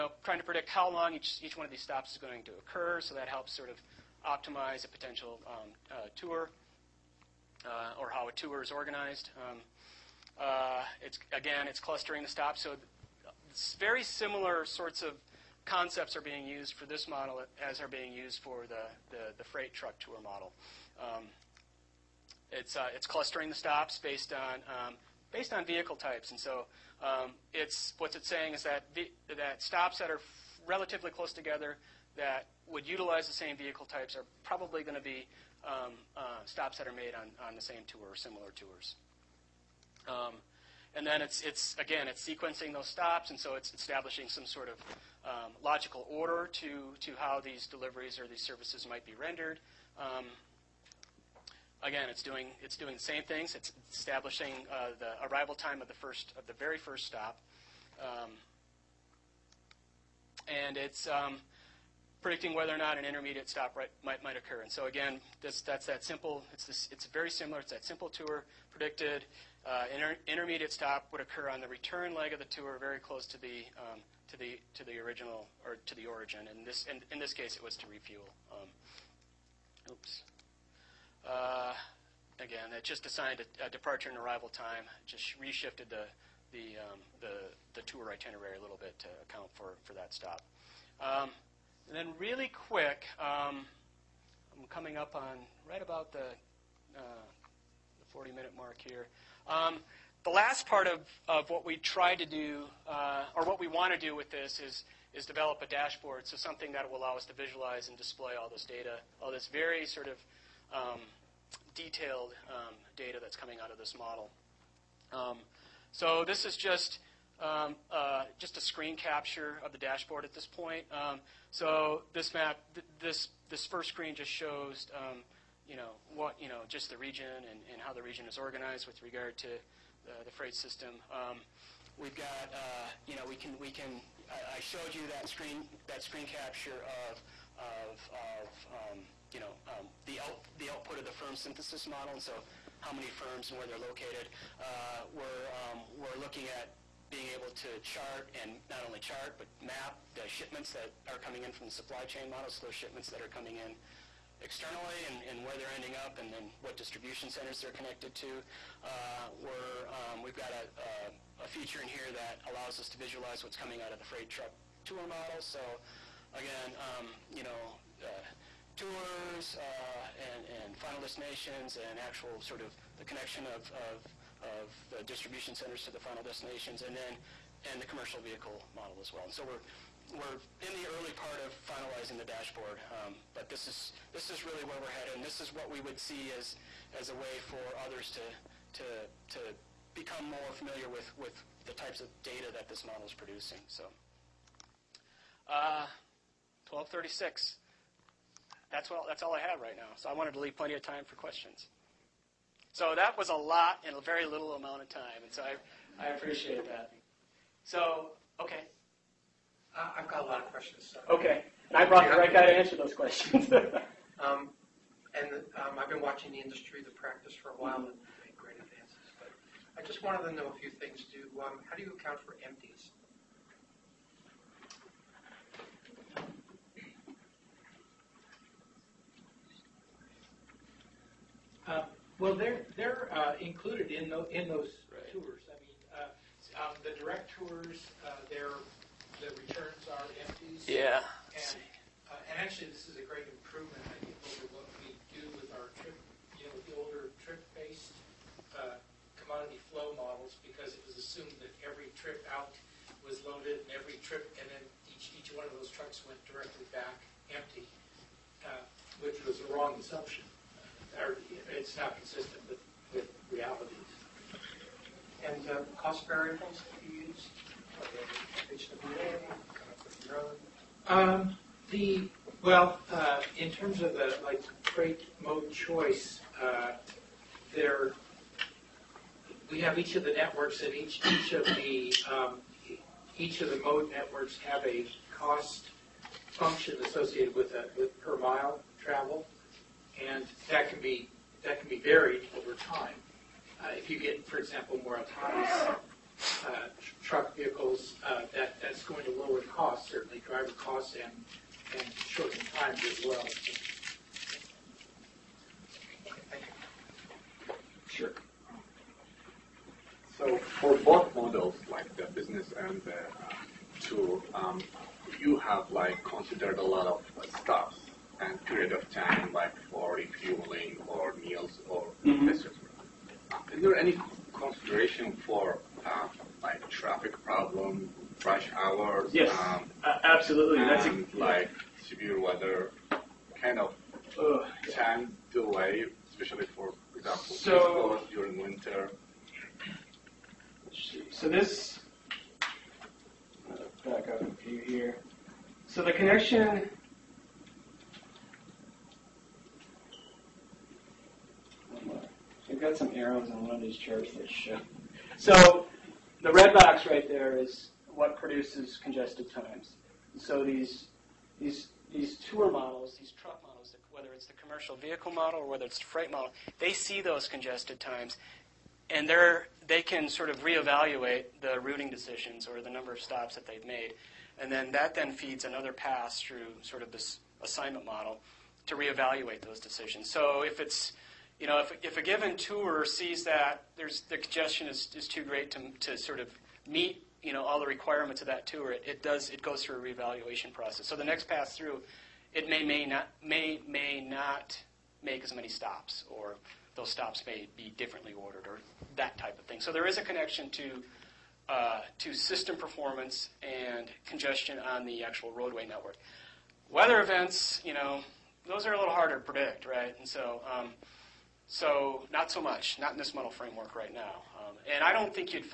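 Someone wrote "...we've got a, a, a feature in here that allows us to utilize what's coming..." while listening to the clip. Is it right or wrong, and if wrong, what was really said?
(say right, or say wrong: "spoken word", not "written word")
wrong: "visualize", not "utilize".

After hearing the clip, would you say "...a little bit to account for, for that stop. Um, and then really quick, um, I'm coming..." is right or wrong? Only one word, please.
right.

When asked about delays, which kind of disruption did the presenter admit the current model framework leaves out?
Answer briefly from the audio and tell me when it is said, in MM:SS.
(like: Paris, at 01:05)
Weather events, at 06:46.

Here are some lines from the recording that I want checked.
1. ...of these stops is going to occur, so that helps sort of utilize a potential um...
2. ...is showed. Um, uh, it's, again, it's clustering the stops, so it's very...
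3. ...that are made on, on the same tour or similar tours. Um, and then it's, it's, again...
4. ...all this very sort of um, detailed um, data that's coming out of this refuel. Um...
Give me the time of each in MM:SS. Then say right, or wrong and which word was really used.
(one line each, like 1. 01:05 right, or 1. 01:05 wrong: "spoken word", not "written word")
1. 00:01 wrong: "optimize", not "utilize"
2. 00:08 wrong: "organized", not "showed"
3. 00:36 right
4. 01:49 wrong: "model", not "refuel".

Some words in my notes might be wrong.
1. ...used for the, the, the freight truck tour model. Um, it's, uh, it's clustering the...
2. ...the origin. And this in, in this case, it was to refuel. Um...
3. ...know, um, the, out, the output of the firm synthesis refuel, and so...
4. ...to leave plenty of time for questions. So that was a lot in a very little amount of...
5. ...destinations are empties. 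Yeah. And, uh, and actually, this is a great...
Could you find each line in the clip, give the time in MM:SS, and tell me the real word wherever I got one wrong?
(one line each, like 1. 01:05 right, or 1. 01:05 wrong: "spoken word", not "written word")
1. 00:18 right
2. 01:15 right
3. 02:19 wrong: "model", not "refuel"
4. 03:20 right
5. 03:59 wrong: "returns", not "destinations".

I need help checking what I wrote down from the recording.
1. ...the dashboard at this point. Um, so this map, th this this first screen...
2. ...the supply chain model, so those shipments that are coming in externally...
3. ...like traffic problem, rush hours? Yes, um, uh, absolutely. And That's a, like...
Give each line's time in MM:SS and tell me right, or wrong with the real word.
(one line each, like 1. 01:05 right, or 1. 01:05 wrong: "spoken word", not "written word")
1. 01:59 right
2. 02:31 right
3. 05:26 right.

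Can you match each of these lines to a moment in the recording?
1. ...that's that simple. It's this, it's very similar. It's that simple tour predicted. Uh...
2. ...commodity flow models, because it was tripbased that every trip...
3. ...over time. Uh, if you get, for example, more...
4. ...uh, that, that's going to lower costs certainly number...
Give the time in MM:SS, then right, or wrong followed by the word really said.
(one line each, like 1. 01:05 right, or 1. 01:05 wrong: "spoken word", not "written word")
1. 01:05 right
2. 04:09 wrong: "assumed", not "tripbased"
3. 04:52 right
4. 04:58 wrong: "driver", not "number".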